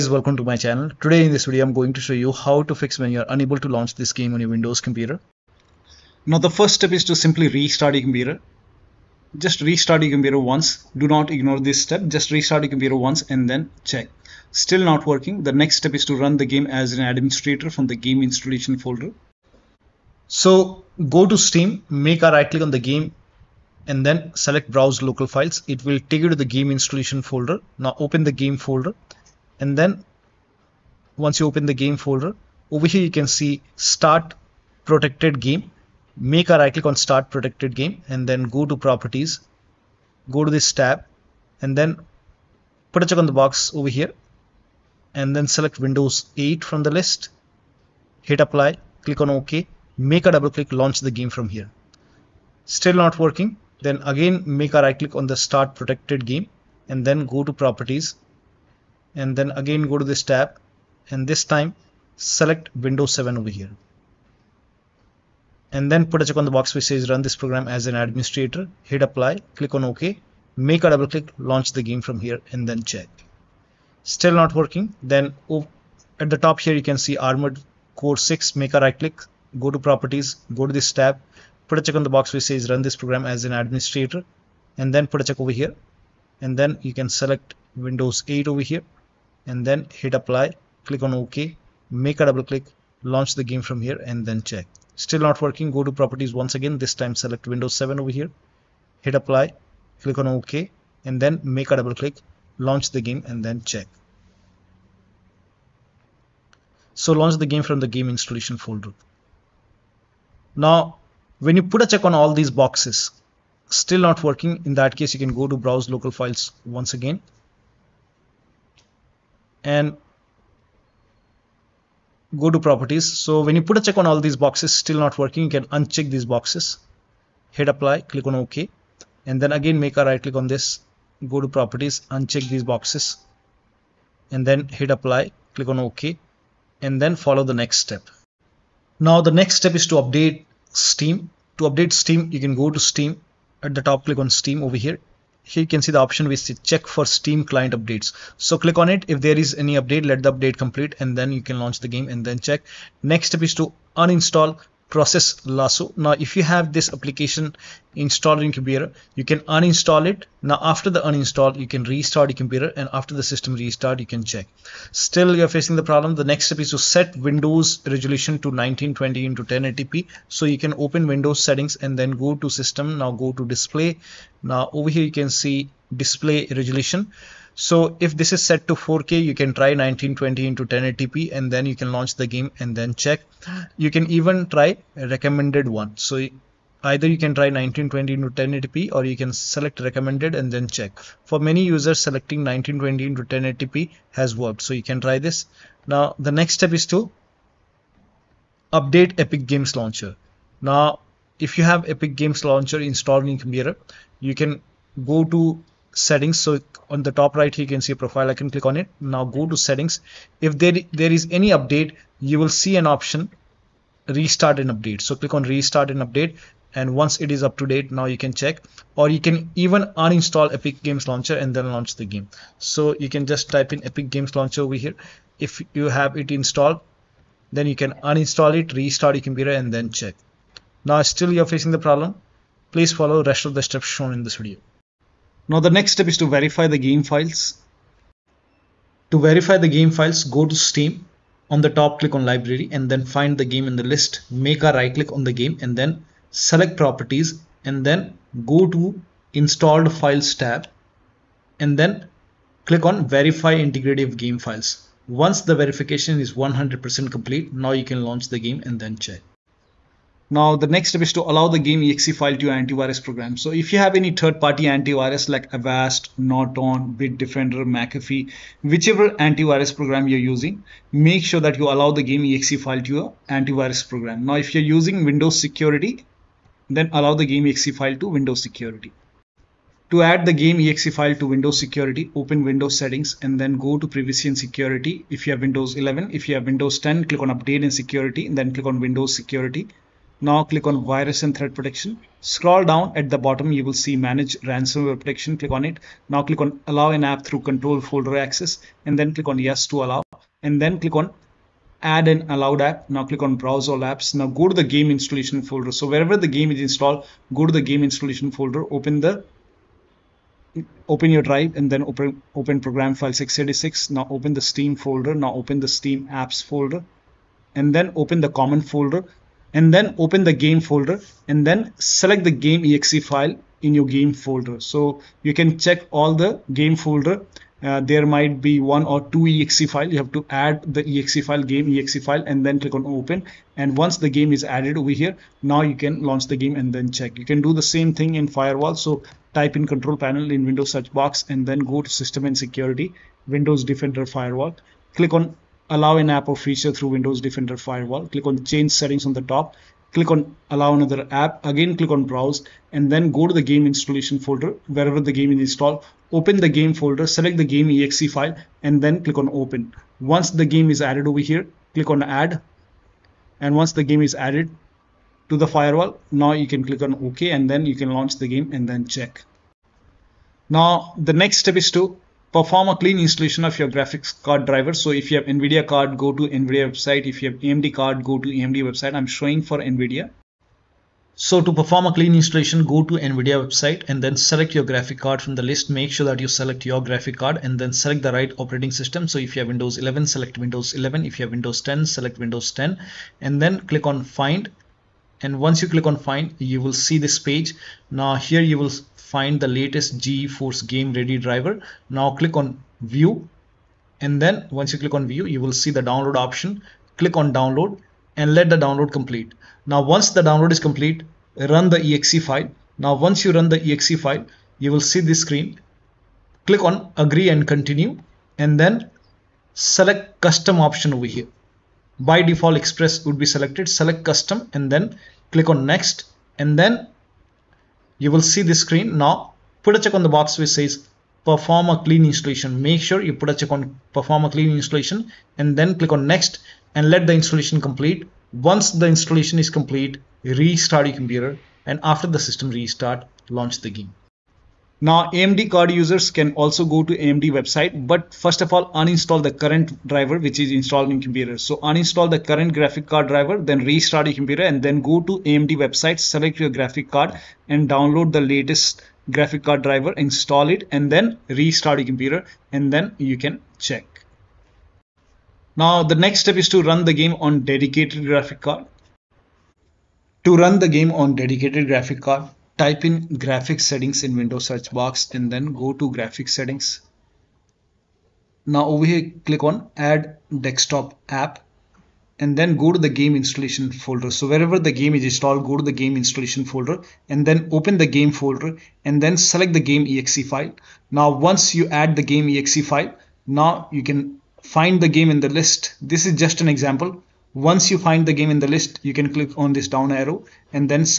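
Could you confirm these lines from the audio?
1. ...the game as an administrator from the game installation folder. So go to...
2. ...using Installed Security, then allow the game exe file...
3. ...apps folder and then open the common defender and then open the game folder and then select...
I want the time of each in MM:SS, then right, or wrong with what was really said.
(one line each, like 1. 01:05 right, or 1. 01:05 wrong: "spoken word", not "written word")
1. 00:16 right
2. 04:34 wrong: "Windows", not "Installed"
3. 05:16 wrong: "folder", not "defender".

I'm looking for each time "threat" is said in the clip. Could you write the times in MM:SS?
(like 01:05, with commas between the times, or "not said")
04:51.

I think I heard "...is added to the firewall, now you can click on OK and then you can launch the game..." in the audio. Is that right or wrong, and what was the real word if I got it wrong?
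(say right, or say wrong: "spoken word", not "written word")
right.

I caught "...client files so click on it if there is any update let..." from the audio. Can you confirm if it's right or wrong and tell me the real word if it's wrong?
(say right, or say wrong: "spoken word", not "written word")
wrong: "updates", not "files".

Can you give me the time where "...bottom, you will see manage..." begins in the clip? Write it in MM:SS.
04:53.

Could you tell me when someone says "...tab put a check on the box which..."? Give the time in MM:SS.
01:20.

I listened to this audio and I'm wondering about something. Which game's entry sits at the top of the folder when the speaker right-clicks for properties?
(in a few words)
Armored Core 6.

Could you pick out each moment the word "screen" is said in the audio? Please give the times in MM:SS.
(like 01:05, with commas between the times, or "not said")
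06:55, 07:08.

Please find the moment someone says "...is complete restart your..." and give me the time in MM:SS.
07:19.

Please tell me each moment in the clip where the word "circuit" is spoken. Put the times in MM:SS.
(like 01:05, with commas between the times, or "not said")
not said.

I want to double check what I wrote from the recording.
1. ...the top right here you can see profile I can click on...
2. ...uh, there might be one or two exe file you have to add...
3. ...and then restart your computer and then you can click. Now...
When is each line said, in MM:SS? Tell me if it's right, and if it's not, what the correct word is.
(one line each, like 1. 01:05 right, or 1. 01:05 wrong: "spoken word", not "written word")
1. 03:27 right
2. 05:27 right
3. 07:40 wrong: "check", not "click".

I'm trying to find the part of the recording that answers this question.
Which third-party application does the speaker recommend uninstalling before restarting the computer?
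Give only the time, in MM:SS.
02:34.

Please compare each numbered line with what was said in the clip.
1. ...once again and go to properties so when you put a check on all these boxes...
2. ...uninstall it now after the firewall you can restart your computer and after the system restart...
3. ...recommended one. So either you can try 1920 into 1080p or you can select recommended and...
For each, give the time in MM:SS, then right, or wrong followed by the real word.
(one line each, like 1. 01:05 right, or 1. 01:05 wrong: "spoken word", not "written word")
1. 01:56 right
2. 02:39 wrong: "uninstall", not "firewall"
3. 03:04 right.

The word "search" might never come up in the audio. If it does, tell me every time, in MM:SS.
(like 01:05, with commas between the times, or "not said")
05:40, 07:54.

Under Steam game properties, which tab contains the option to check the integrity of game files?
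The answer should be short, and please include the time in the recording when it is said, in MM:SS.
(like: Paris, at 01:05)
Installed Files, at 04:09.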